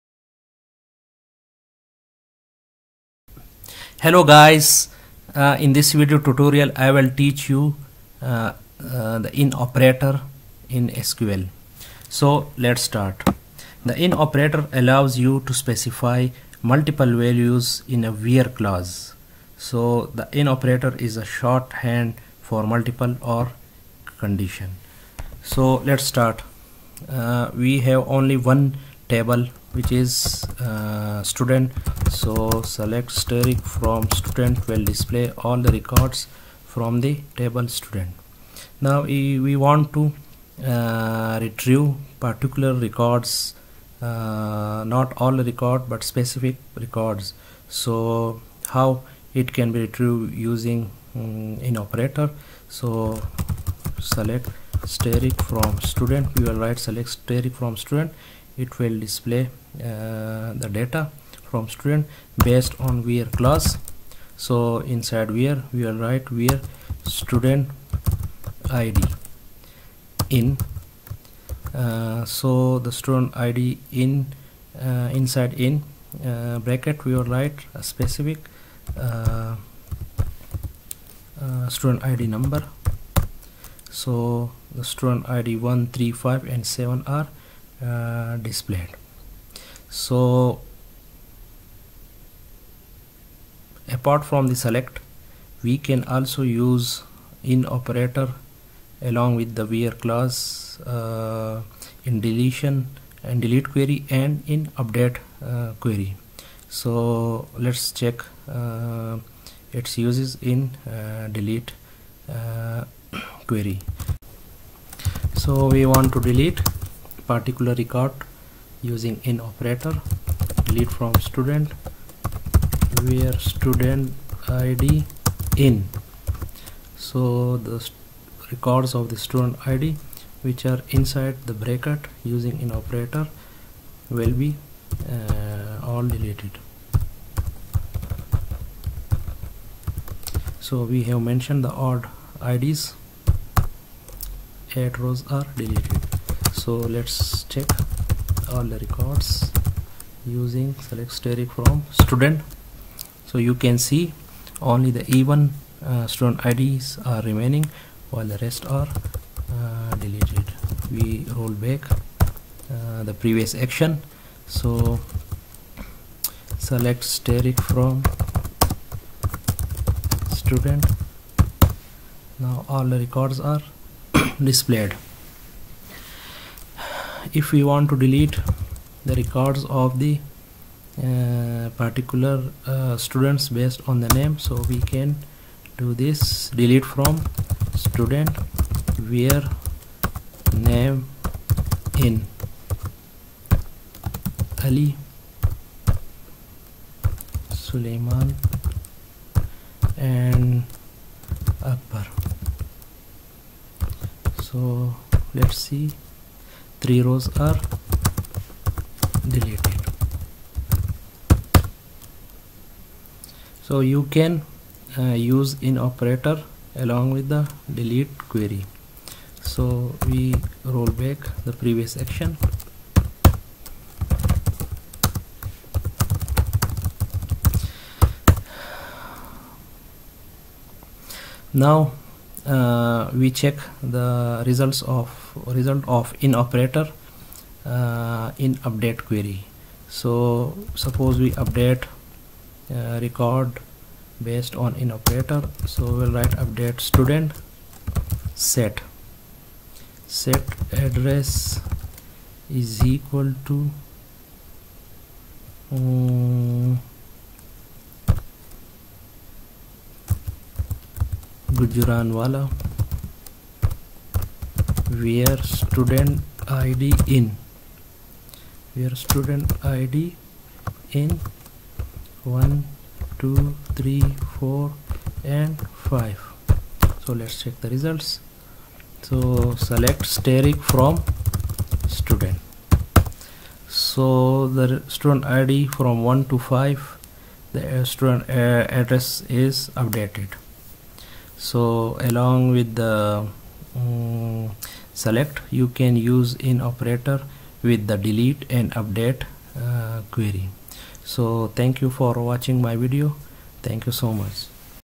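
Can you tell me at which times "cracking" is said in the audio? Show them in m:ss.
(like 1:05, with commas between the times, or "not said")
not said.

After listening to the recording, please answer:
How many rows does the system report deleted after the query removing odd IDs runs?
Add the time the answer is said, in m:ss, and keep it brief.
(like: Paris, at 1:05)
8, at 2:24.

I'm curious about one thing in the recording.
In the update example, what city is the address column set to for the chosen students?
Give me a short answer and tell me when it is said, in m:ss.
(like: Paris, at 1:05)
Gujranwala, at 4:21.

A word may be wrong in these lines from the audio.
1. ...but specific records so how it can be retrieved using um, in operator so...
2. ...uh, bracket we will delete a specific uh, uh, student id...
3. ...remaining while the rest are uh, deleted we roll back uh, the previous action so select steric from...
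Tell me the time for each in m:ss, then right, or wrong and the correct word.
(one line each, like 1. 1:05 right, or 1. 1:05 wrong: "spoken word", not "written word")
1. 0:45 right
2. 1:16 wrong: "write", not "delete"
3. 2:37 right.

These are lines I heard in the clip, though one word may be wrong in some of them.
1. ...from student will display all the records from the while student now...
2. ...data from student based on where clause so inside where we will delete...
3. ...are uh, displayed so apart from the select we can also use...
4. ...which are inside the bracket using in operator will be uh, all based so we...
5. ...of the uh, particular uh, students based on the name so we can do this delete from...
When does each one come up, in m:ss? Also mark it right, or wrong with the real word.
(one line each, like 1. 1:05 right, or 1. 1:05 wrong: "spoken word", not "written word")
1. 0:33 wrong: "table", not "while"
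2. 1:00 wrong: "write", not "delete"
3. 1:27 right
4. 2:10 wrong: "deleted", not "based"
5. 2:59 right.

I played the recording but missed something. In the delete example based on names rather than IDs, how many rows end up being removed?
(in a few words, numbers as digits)
3.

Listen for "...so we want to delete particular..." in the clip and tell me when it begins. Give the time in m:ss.
1:55.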